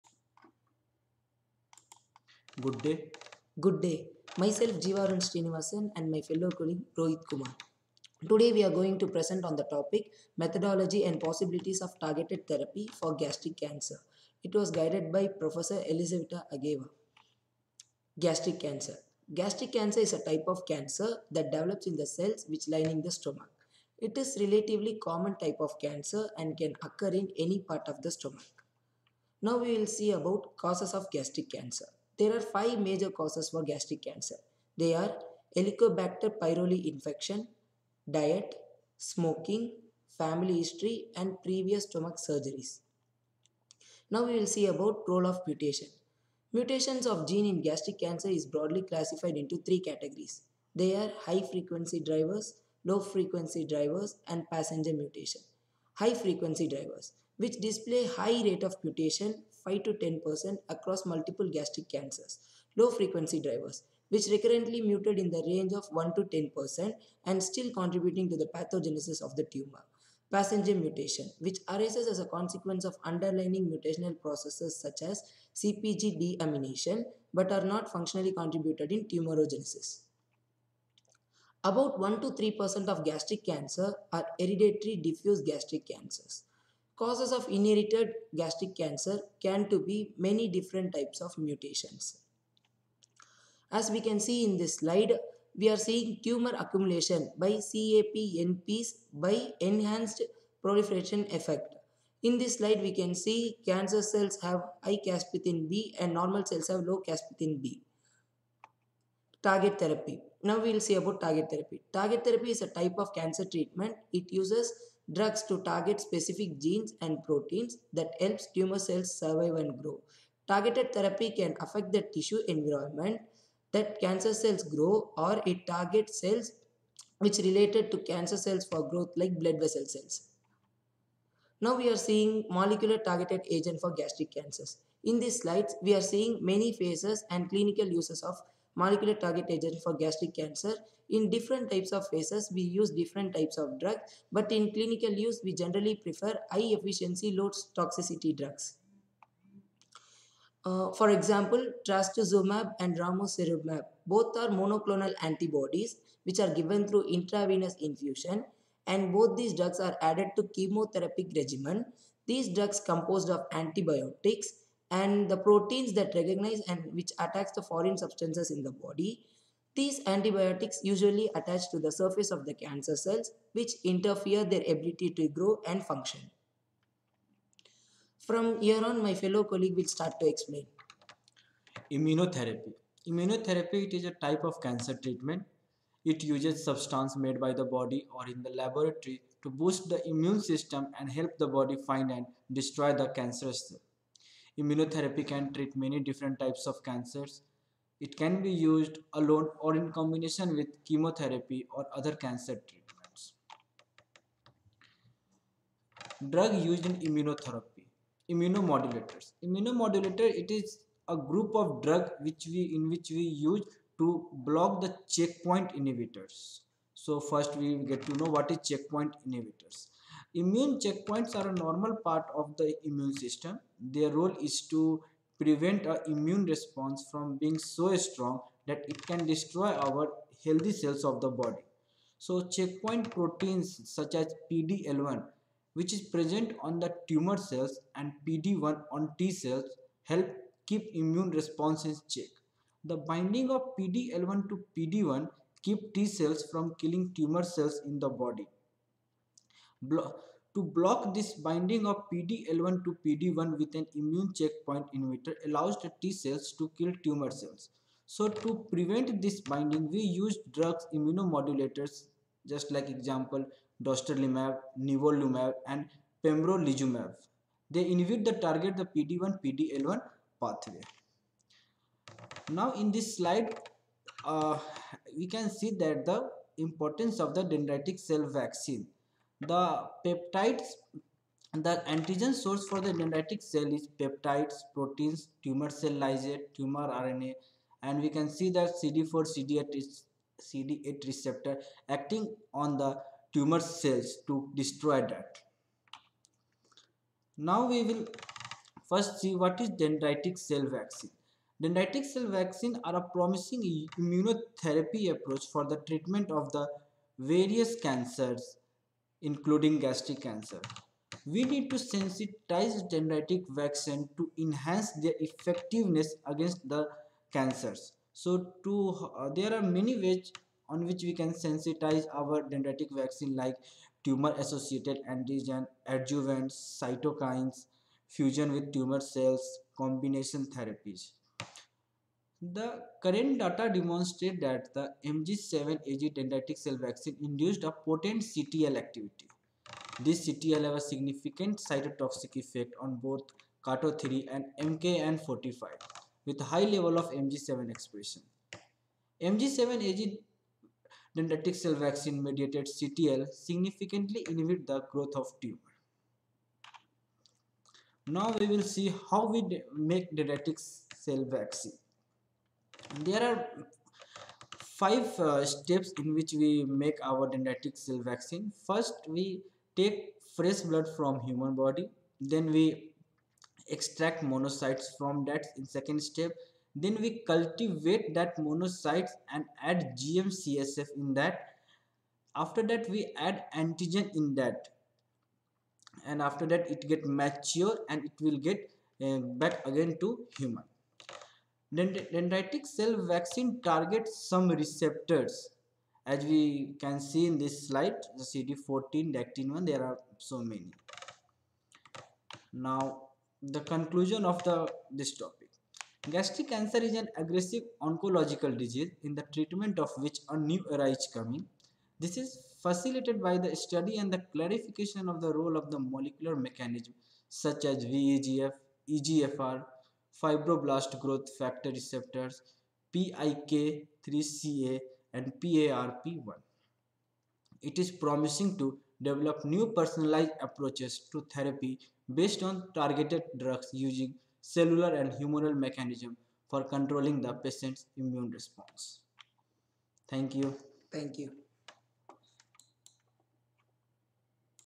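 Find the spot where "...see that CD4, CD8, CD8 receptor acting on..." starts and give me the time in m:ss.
4:48.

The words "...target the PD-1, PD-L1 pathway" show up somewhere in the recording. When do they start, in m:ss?
4:28.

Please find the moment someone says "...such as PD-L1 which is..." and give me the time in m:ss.
3:53.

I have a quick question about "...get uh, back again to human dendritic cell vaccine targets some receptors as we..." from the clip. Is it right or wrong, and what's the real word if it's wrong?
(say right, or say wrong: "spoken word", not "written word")
right.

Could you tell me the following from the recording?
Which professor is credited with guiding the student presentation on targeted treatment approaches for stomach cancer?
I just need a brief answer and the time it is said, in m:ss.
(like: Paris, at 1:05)
Elisaveta Ageeva, at 0:15.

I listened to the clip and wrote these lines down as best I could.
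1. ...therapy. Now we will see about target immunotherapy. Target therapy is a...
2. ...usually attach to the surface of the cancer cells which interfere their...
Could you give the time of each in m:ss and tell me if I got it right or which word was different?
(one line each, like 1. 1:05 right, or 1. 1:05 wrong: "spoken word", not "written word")
1. 1:49 wrong: "therapy", not "immunotherapy"
2. 2:50 right.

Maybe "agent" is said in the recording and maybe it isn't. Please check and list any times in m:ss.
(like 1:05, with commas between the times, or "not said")
2:13, 2:19.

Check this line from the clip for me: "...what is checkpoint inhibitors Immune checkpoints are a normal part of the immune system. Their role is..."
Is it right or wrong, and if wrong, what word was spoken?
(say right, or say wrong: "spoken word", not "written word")
right.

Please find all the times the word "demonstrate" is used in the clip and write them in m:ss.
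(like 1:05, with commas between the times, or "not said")
5:33.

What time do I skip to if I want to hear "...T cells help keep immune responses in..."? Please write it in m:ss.
3:59.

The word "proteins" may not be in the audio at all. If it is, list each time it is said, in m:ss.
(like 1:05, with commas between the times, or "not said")
1:57, 2:45, 3:53, 4:44.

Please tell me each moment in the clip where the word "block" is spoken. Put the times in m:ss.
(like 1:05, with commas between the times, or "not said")
3:34, 4:10.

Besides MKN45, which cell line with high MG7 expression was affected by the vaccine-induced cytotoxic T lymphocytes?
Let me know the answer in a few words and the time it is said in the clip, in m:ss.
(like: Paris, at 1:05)
KATO3, at 5:43.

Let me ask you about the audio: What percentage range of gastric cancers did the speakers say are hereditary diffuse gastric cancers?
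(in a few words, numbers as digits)
1 to 3%.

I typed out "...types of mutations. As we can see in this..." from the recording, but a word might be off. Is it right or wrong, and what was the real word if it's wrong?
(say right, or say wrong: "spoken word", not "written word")
right.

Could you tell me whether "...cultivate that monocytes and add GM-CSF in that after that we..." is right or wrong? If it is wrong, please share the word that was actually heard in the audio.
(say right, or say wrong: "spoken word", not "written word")
right.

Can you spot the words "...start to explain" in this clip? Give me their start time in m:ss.
2:59.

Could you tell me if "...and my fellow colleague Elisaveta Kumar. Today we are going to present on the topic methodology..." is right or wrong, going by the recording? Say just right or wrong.
wrong.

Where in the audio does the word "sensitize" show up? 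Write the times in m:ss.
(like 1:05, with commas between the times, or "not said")
5:11, 5:21.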